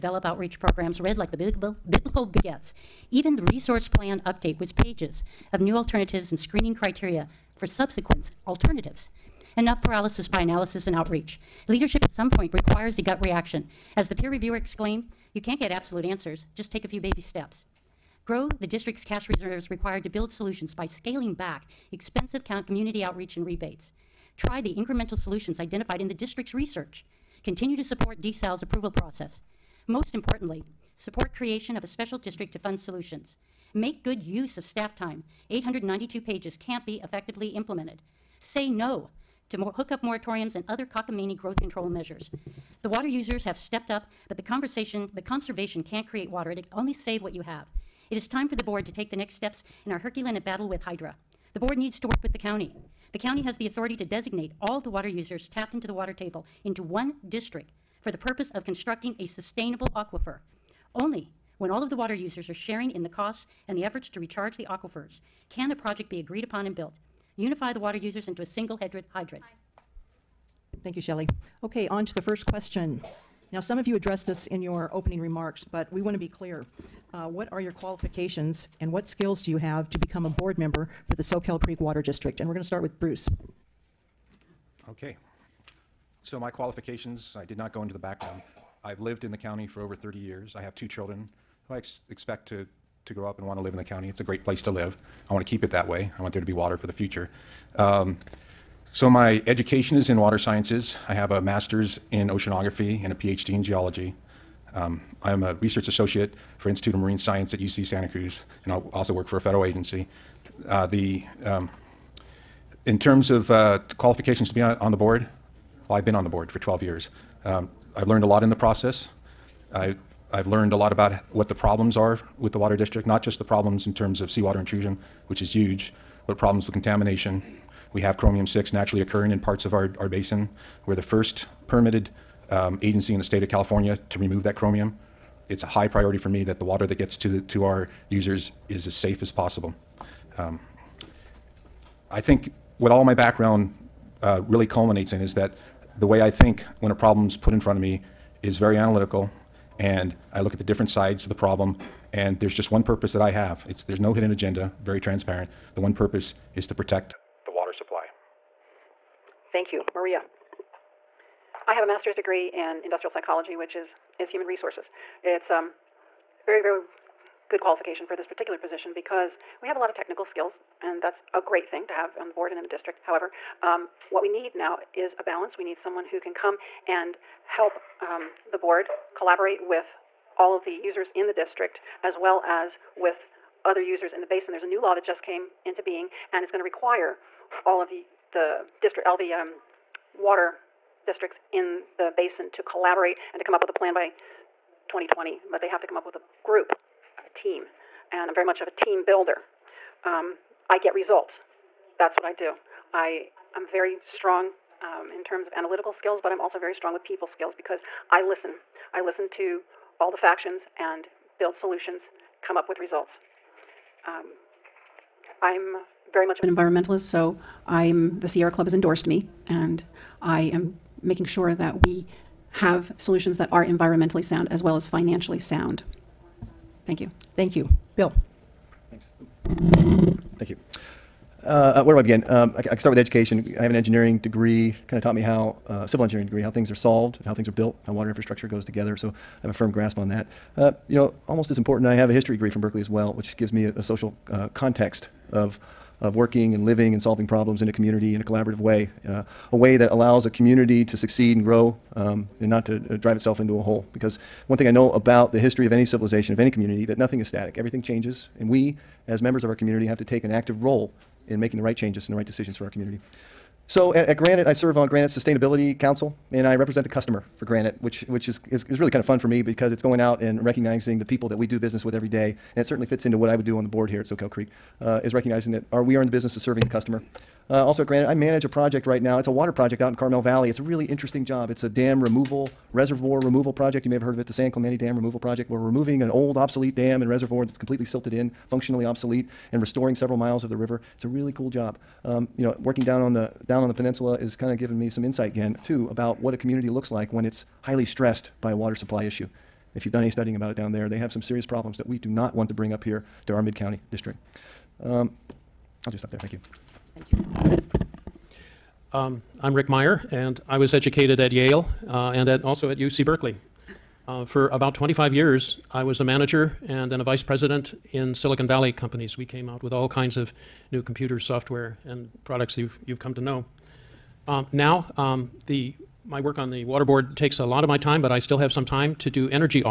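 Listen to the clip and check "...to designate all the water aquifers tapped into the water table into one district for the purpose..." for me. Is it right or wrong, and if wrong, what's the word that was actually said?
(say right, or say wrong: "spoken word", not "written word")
wrong: "users", not "aquifers".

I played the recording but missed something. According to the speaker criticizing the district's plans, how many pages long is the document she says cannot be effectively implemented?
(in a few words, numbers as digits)
892.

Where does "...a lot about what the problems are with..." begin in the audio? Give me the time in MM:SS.
02:00.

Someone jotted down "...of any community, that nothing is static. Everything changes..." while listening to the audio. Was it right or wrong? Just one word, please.
right.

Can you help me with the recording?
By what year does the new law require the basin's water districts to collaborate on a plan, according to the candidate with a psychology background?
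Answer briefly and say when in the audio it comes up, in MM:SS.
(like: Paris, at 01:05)
2020, at 03:14.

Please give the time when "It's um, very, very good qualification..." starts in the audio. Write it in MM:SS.
02:45.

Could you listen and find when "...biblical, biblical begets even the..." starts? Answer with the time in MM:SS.
00:01.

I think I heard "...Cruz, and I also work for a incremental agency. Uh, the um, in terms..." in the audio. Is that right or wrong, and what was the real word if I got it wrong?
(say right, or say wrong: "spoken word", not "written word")
wrong: "federal", not "incremental".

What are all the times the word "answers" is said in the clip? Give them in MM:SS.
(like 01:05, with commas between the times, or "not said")
00:16.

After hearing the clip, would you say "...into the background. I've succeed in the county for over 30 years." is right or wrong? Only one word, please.
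wrong.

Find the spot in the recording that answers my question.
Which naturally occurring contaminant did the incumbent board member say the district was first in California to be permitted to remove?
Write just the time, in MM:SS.
02:08.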